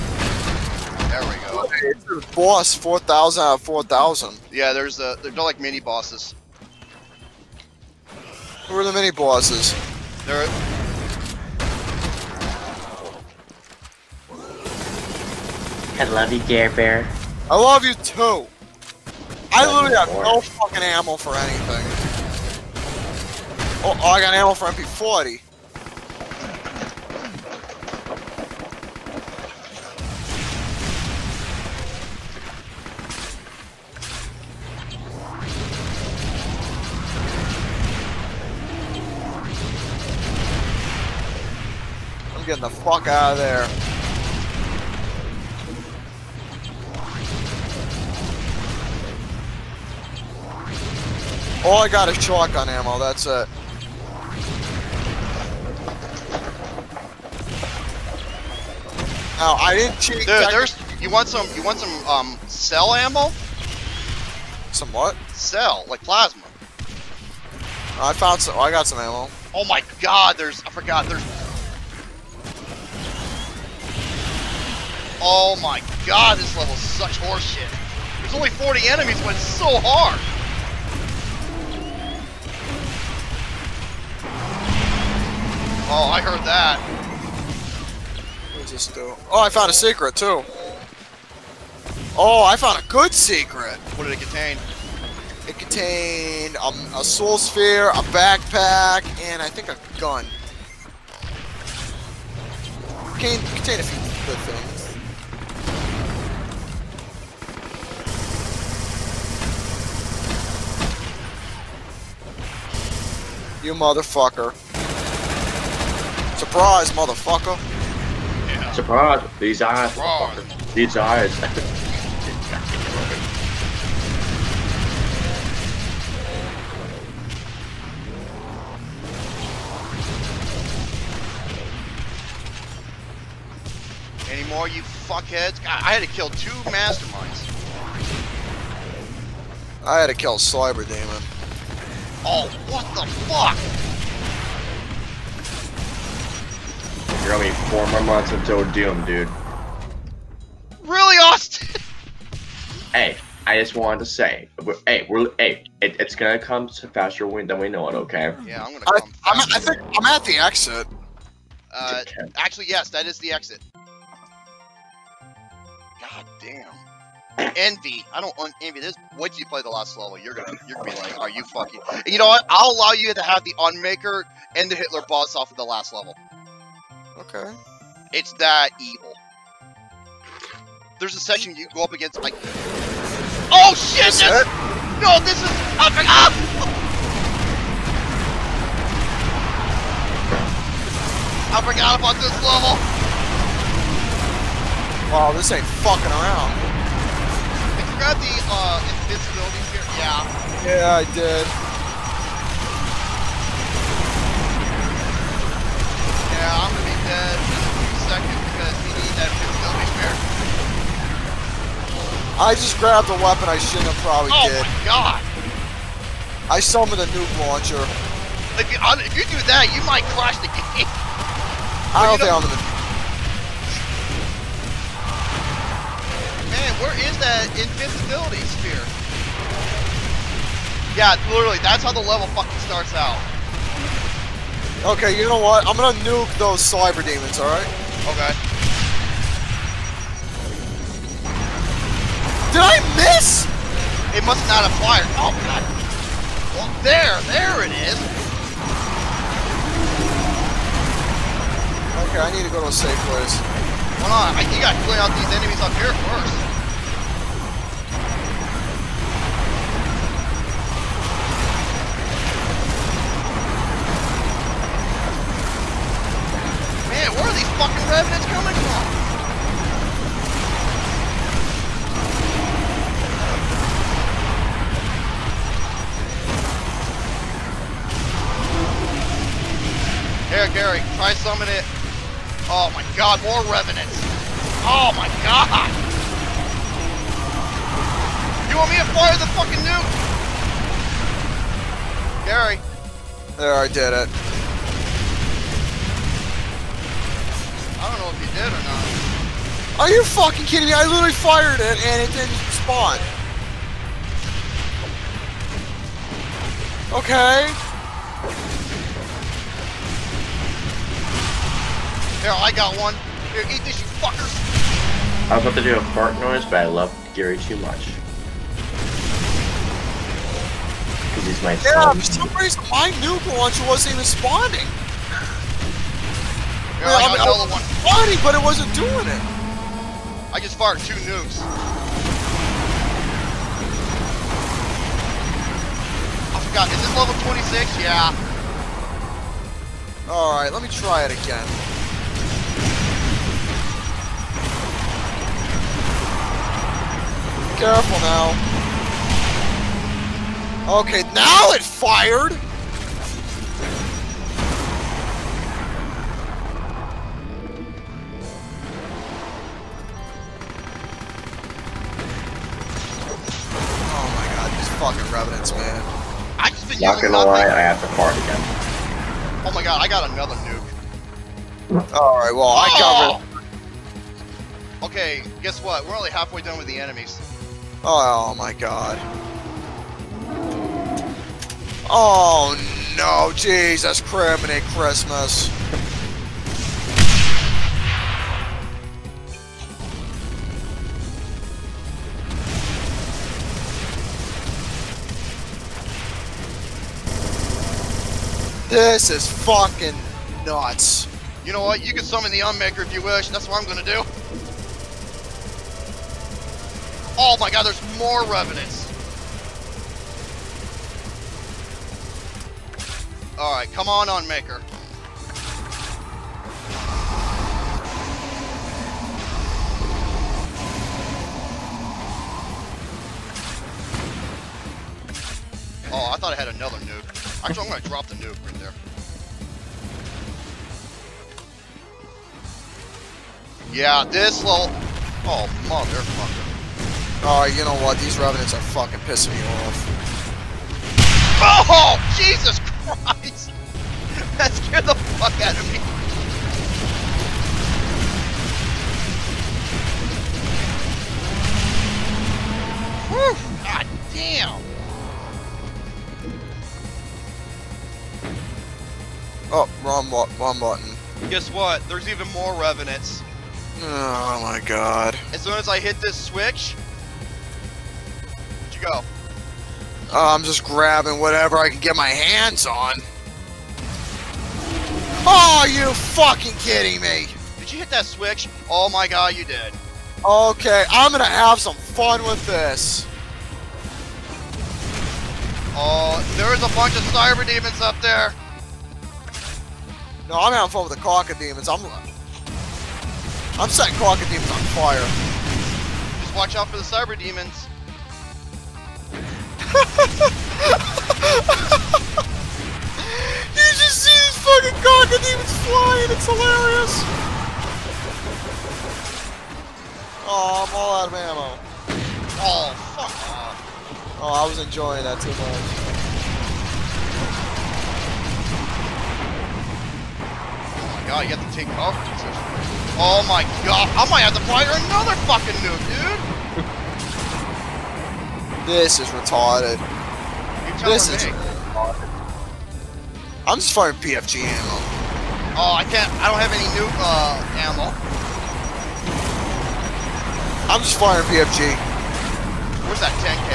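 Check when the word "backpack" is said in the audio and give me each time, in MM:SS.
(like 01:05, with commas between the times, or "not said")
01:38.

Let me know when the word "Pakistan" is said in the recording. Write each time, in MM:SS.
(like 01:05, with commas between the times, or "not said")
not said.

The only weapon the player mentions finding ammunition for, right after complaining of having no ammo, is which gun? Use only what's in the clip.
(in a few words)
MP40.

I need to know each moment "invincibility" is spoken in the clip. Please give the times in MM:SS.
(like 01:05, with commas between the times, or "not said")
03:19, 03:29, 03:47.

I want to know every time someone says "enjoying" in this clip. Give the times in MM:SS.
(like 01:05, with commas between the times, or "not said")
08:34.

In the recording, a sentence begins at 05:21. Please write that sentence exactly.
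for some reason my nuke launcher wasn't even spawning.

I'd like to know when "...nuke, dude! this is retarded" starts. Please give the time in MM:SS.
08:45.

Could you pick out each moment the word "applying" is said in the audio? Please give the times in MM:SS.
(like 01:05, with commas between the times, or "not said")
not said.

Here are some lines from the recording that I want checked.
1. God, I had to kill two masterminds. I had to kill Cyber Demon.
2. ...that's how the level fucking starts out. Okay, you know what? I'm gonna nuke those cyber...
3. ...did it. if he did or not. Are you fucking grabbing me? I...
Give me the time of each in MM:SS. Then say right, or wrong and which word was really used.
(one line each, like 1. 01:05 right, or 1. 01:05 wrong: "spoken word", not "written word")
1. 02:15 right
2. 03:51 right
3. 04:53 wrong: "kidding", not "grabbing".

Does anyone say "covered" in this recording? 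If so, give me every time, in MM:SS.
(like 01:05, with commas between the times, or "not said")
06:13.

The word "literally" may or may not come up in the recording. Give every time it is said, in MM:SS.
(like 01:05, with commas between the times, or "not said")
00:19, 03:51, 05:00.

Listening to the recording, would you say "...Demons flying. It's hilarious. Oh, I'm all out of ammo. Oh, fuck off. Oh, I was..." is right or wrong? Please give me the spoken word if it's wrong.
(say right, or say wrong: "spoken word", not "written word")
right.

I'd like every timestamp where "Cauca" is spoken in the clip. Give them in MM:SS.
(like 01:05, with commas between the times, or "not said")
08:24.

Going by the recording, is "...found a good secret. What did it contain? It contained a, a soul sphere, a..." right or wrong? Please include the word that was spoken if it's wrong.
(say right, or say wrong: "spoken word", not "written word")
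right.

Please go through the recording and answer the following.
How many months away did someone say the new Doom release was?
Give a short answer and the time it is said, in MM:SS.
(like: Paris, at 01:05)
four, at 02:27.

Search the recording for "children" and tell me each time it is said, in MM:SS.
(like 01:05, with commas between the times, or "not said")
not said.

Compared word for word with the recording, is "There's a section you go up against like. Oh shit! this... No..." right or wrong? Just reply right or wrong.
right.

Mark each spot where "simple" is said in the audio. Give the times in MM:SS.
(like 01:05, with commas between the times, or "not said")
not said.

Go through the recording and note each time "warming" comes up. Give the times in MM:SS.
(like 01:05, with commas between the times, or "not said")
not said.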